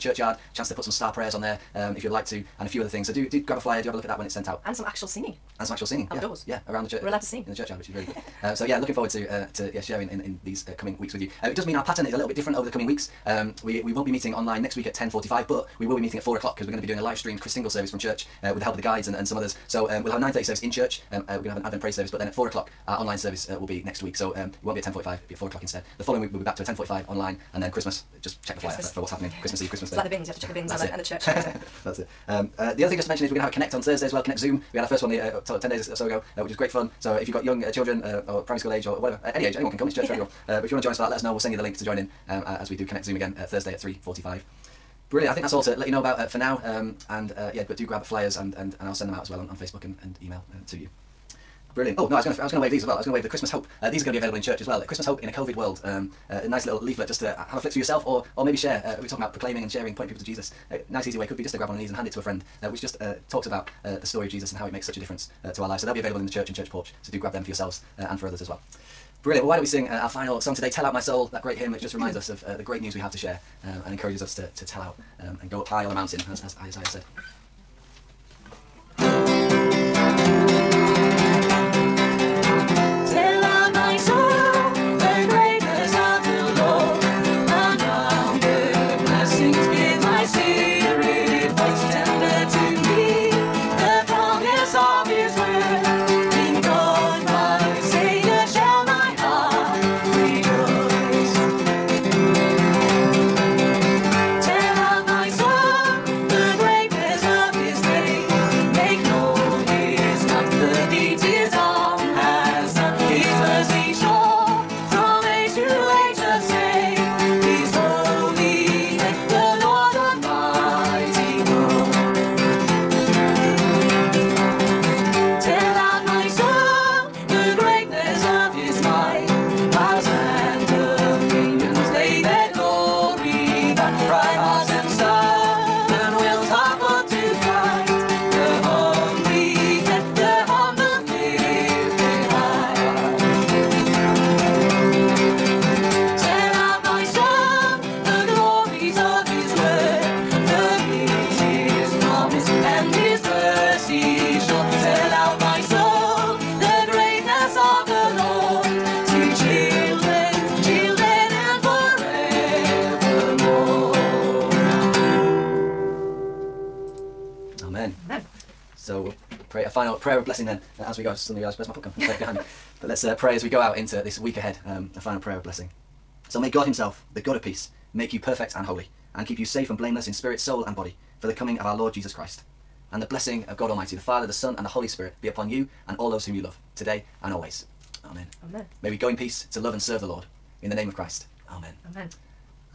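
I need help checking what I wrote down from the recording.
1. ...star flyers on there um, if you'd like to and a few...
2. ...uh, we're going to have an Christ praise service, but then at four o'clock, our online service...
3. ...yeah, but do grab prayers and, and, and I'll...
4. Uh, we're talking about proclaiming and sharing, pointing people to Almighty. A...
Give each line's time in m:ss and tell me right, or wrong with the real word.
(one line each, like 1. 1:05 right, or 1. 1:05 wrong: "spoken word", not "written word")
1. 0:00 wrong: "prayers", not "flyers"
2. 0:21 wrong: "Advent", not "Christ"
3. 0:47 wrong: "flyers", not "prayers"
4. 0:58 wrong: "Jesus", not "Almighty".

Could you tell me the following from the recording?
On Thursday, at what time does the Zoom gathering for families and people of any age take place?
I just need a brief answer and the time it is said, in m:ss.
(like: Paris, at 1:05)
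3.45, at 0:43.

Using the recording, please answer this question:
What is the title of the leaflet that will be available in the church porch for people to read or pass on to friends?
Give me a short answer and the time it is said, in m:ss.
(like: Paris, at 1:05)
Christmas Hope in a COVID World, at 0:54.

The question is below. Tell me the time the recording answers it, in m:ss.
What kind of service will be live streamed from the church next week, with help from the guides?
0:17.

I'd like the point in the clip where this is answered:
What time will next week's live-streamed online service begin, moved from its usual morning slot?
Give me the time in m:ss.
0:16.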